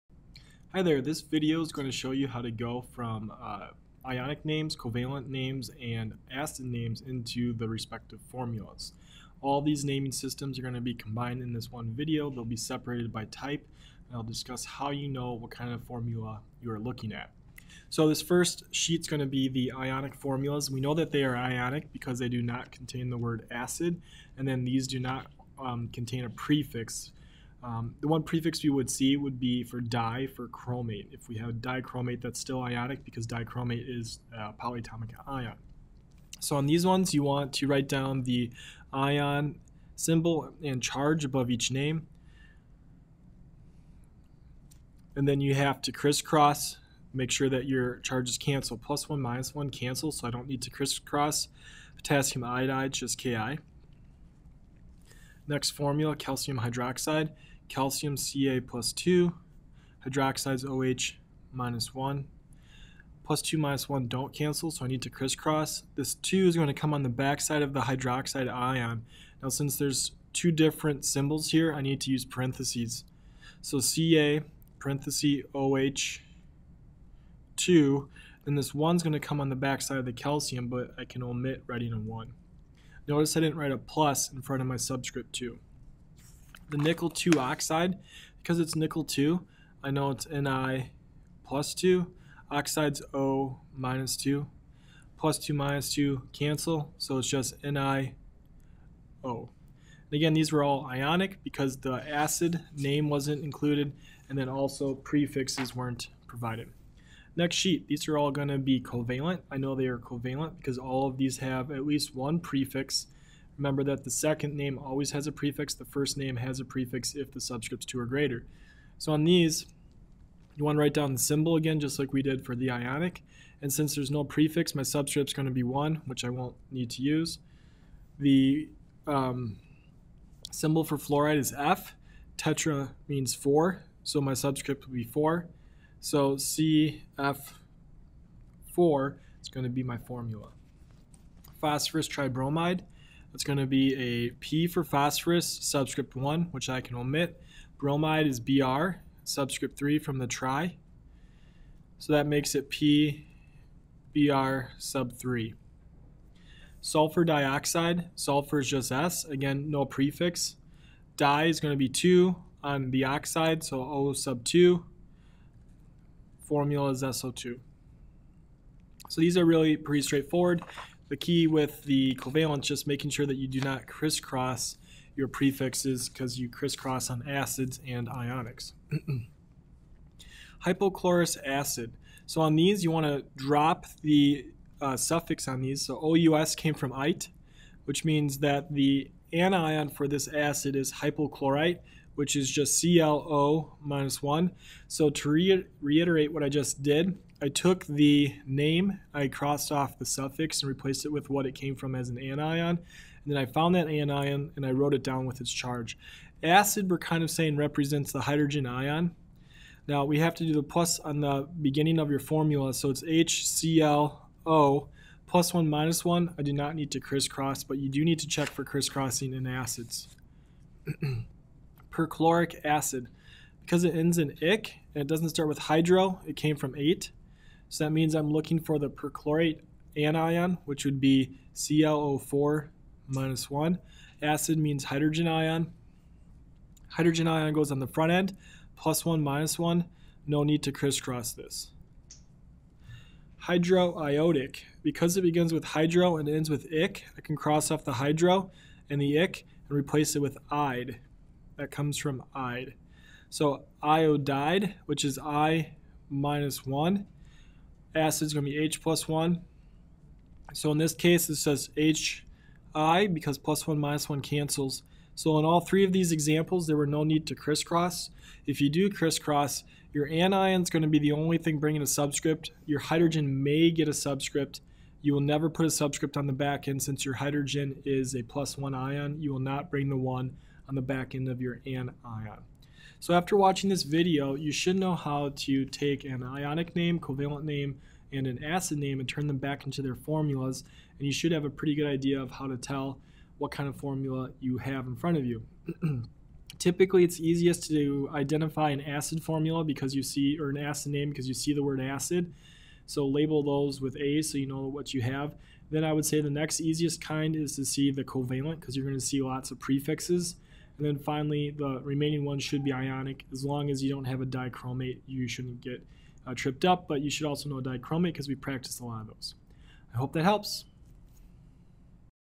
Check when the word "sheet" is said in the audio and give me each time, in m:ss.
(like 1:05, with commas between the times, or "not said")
0:18, 1:47.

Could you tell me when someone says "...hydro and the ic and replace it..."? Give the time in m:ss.
4:07.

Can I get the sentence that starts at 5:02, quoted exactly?
So label those with A so you know what you have.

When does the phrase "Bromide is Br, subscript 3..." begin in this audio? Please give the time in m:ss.
2:27.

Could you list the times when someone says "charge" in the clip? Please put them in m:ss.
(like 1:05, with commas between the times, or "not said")
0:40, 0:47, 3:25.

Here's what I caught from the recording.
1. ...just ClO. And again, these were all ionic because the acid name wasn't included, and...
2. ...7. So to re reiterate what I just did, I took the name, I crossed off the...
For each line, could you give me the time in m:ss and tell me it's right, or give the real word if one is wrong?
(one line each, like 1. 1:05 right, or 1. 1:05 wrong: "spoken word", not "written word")
1. 1:37 wrong: "NiO", not "ClO"
2. 3:14 wrong: "1", not "7".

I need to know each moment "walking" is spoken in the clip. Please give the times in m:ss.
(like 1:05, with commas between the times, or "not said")
not said.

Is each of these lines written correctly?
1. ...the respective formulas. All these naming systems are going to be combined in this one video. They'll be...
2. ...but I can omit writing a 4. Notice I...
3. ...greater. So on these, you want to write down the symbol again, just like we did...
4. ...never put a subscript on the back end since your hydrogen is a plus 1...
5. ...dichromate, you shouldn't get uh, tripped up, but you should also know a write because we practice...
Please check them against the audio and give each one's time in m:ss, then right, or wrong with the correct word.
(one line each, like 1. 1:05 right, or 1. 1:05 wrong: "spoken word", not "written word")
1. 0:07 right
2. 1:20 wrong: "1", not "4"
3. 1:58 right
4. 4:35 right
5. 5:14 wrong: "dichromate", not "write".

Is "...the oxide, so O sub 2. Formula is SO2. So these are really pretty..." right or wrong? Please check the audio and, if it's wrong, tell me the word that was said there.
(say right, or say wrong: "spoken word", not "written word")
right.